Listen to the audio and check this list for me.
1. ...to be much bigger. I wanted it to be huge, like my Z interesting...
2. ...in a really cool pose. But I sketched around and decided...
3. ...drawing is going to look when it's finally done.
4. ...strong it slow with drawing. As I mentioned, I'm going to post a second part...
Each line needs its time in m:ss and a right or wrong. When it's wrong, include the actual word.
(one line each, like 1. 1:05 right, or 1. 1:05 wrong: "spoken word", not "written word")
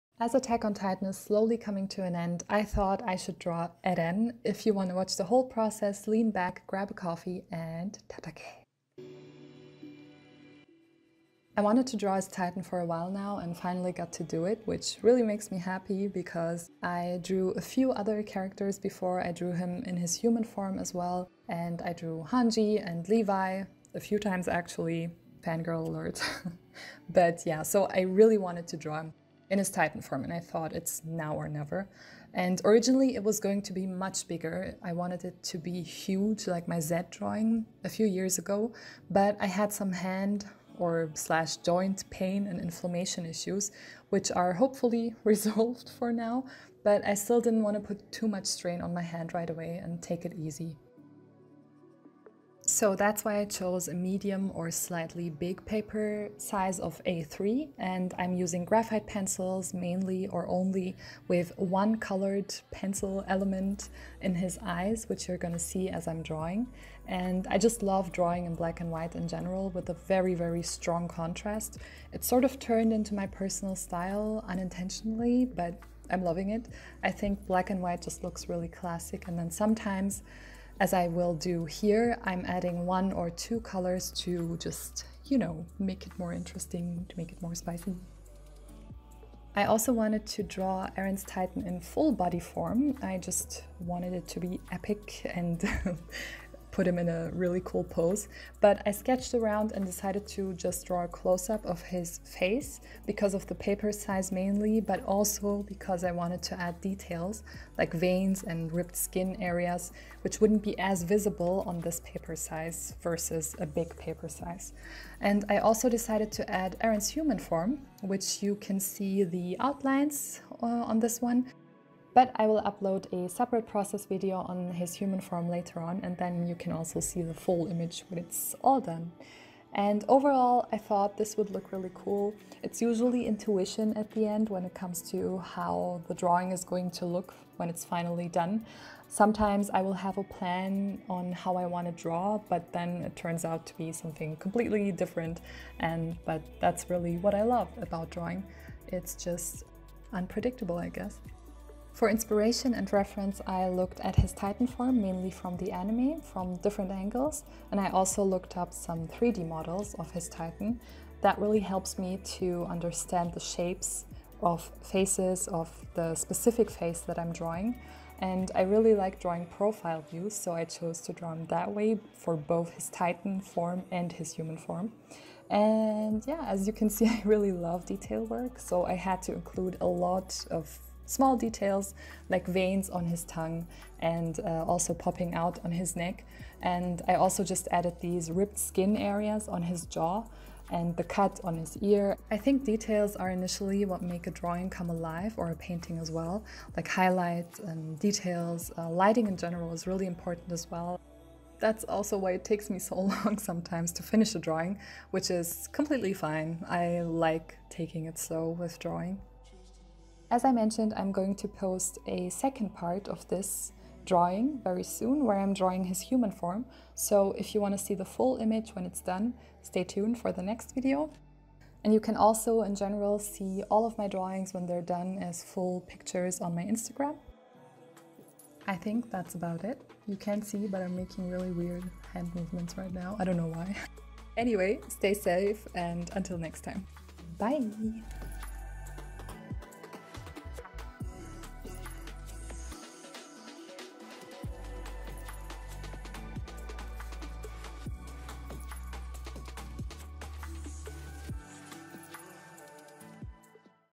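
1. 0:33 wrong: "drawing", not "interesting"
2. 1:36 right
3. 2:16 right
4. 3:27 wrong: "taking", not "strong".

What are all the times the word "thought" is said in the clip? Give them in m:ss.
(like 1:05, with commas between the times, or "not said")
0:02, 0:30, 2:10.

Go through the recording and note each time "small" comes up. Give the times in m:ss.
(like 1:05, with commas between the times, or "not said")
3:01.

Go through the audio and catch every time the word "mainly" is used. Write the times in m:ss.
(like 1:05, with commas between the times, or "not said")
0:59, 1:44, 2:35.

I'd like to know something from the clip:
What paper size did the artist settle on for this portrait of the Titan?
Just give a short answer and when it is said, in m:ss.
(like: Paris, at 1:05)
A3, at 0:57.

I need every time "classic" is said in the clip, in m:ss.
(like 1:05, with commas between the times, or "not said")
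1:18.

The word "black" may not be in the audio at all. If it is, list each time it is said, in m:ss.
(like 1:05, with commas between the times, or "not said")
1:08, 1:17.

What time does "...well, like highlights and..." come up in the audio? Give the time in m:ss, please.
3:16.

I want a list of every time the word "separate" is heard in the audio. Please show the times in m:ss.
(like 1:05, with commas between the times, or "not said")
2:03.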